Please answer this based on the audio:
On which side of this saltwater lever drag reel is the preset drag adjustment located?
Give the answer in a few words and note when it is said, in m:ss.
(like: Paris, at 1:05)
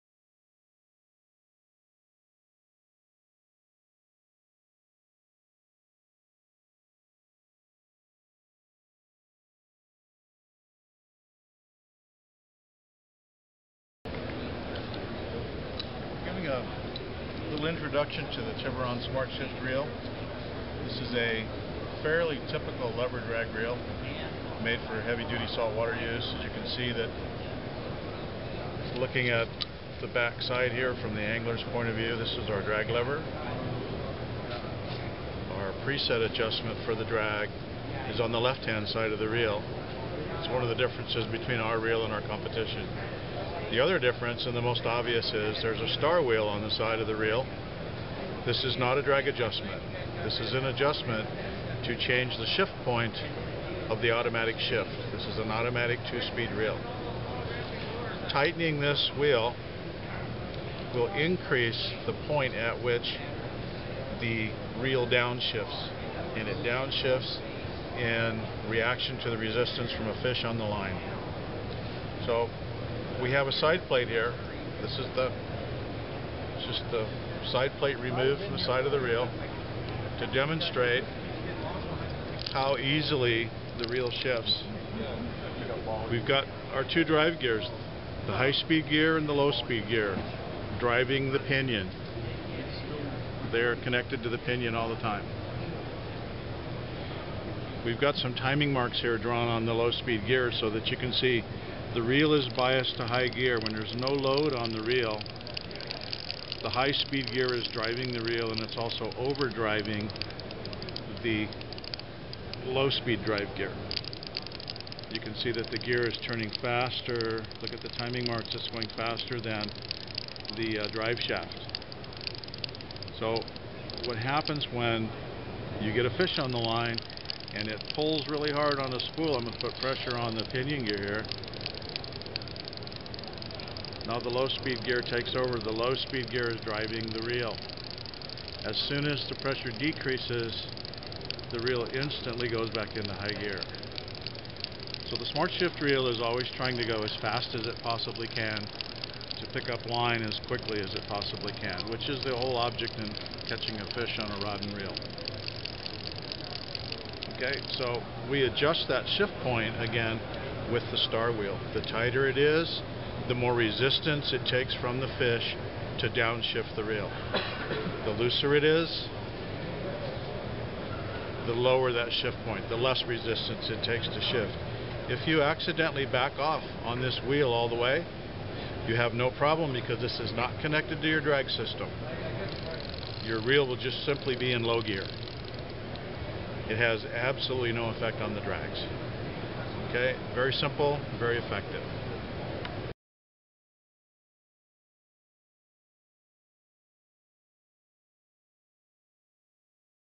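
left hand side, at 0:38.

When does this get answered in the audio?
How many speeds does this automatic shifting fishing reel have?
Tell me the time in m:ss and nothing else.
0:56.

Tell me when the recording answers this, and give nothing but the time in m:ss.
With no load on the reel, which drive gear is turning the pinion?
1:46.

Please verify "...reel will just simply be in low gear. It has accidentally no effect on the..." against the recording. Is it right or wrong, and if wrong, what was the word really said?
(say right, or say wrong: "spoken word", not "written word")
wrong: "absolutely", not "accidentally".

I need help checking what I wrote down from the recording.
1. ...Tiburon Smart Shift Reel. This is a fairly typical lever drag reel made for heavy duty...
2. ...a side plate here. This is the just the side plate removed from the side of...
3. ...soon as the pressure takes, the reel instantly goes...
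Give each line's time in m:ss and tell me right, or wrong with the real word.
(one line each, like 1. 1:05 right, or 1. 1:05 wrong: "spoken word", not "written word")
1. 0:18 right
2. 1:13 right
3. 2:18 wrong: "decreases", not "takes".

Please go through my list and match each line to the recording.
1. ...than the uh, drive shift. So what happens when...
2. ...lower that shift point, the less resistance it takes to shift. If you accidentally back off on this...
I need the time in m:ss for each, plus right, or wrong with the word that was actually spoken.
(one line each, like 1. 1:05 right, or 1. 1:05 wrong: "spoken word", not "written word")
1. 1:59 wrong: "shaft", not "shift"
2. 2:51 right.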